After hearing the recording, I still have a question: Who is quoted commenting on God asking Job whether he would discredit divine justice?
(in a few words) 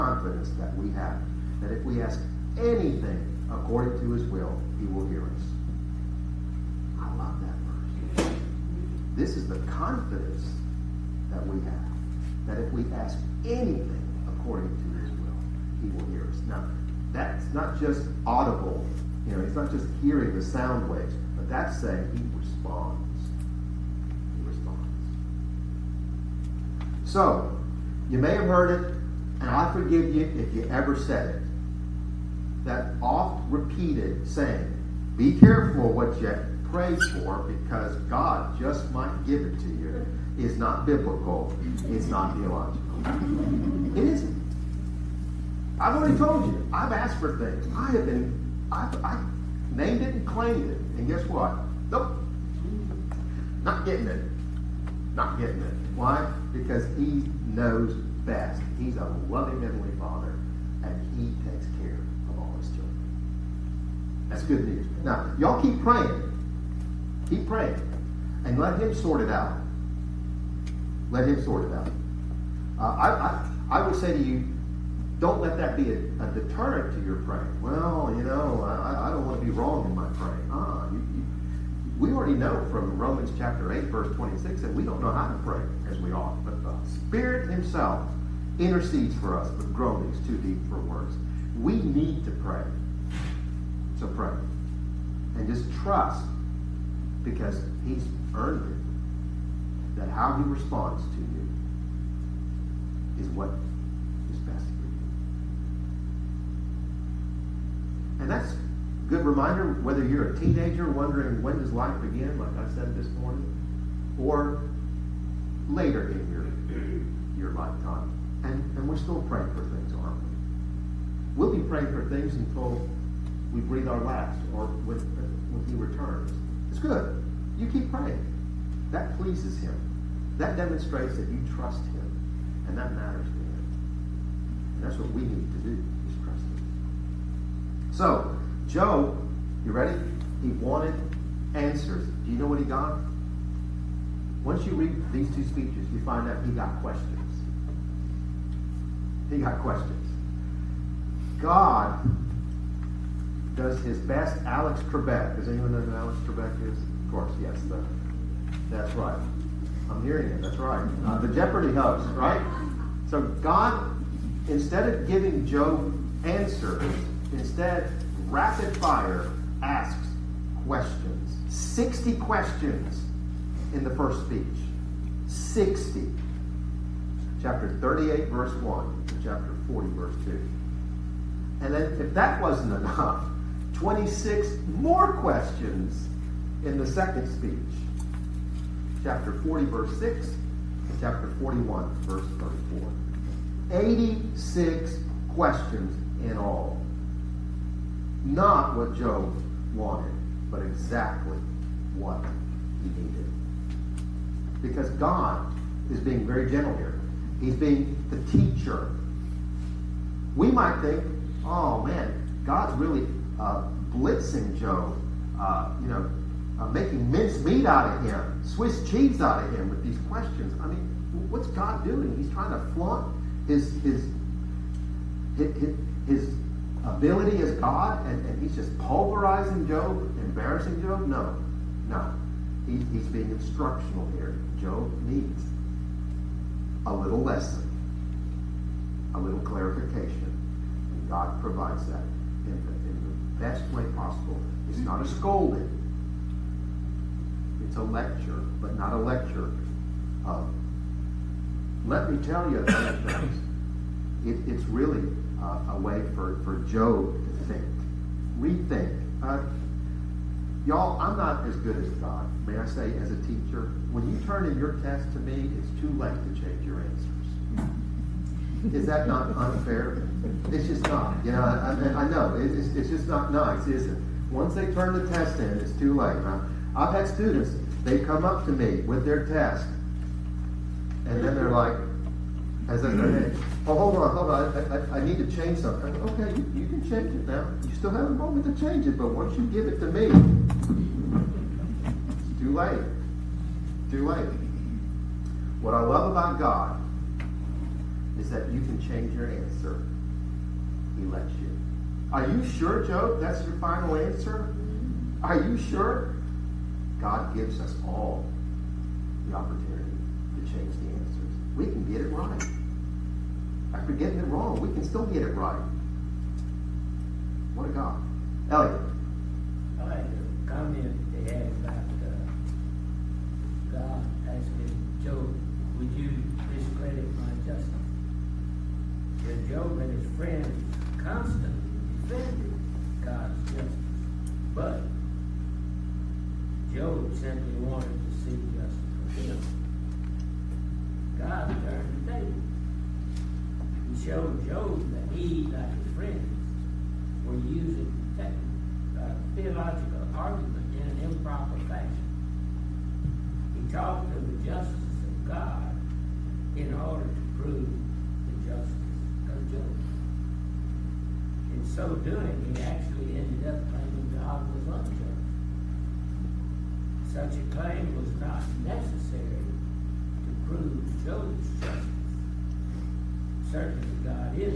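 Elliot.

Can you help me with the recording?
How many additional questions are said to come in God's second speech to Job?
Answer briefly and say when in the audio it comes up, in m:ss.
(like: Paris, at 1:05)
26, at 3:03.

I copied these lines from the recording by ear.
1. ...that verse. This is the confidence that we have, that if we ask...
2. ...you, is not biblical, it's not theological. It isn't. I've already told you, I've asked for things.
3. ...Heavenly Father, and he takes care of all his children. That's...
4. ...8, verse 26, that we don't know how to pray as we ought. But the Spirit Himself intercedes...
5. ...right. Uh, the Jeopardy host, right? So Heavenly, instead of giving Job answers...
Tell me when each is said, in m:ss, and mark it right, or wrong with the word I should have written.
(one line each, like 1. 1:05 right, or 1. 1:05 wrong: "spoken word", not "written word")
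1. 0:07 right
2. 0:39 right
3. 0:59 right
4. 1:23 right
5. 2:40 wrong: "God", not "Heavenly".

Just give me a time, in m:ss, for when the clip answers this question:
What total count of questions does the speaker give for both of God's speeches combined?
3:13.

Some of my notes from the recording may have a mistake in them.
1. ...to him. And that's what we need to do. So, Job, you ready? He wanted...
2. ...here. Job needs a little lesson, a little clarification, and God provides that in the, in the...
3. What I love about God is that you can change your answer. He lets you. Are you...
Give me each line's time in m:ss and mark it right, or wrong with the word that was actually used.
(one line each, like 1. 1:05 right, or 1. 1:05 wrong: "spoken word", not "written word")
1. 2:13 right
2. 3:54 right
3. 4:55 right.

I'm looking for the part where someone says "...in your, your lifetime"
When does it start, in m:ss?
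1:56.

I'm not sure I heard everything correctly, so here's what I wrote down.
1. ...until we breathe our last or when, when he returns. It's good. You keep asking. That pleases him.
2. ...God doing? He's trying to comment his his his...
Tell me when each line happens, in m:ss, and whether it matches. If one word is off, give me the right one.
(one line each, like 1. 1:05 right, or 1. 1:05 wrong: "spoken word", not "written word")
1. 2:02 wrong: "praying", not "asking"
2. 3:41 wrong: "flaunt", not "comment".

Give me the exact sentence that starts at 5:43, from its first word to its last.
and showed Job that he, like his friends, were using technical, uh, theological argument in an improper fashion.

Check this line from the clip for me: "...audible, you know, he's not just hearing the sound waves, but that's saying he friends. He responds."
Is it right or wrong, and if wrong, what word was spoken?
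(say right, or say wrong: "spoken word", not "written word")
wrong: "responds", not "friends".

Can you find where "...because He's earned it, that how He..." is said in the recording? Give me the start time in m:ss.
1:37.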